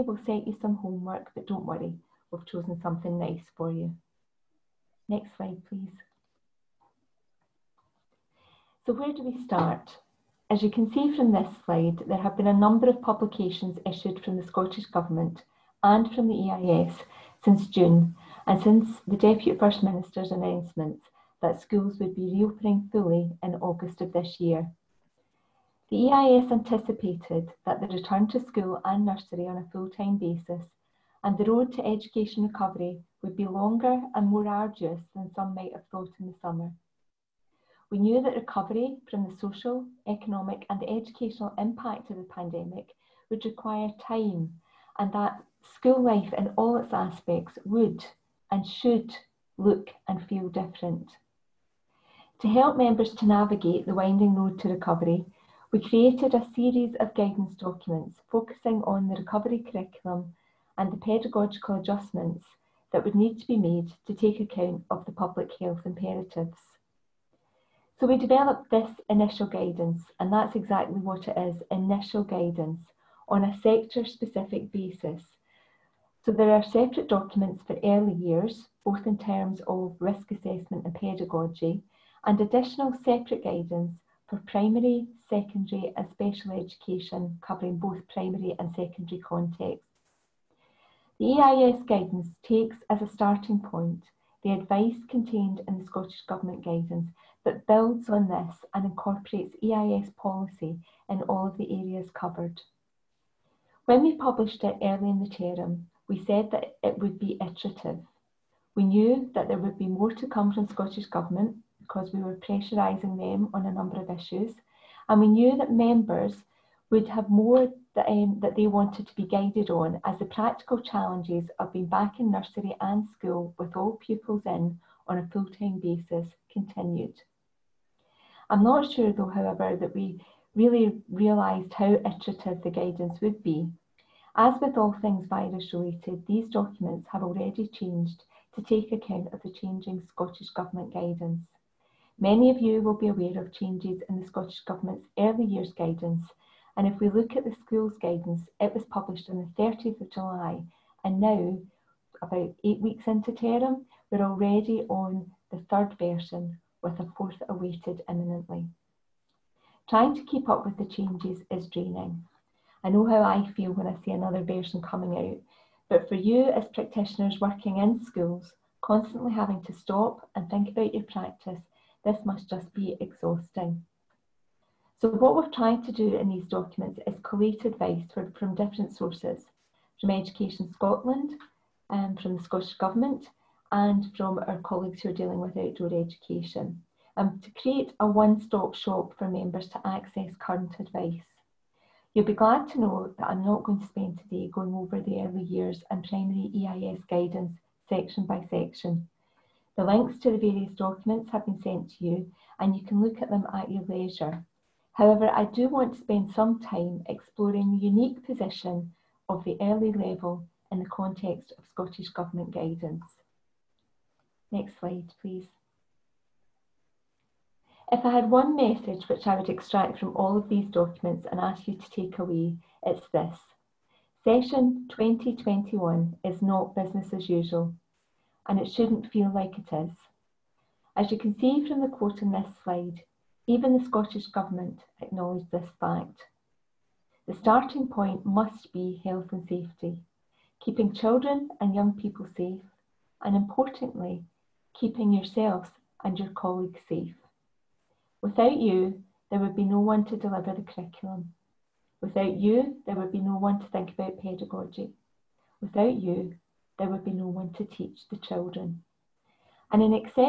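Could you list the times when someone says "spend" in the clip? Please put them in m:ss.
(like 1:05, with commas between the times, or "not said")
3:13, 3:25.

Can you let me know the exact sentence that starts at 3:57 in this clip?
The starting point must be health and safety, keeping children and young people safe, and importantly, keeping yourselves and your colleagues safe.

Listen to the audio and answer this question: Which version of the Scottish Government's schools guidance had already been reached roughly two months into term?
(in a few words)
third.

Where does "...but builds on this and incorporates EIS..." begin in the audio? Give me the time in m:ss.
1:37.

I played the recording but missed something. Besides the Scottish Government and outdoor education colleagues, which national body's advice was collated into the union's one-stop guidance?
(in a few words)
Education Scotland.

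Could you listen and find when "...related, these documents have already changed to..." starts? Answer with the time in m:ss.
2:15.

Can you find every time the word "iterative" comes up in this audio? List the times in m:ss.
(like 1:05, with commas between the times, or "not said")
1:47, 2:11.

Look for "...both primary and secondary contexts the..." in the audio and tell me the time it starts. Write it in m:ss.
1:27.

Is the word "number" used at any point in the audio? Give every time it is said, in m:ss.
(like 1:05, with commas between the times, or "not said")
0:12, 1:53.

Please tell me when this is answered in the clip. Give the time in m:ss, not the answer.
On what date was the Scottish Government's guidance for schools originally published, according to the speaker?
2:29.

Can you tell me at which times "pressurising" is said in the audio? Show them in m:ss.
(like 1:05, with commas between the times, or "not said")
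1:52.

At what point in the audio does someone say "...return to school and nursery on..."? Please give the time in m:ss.
0:27.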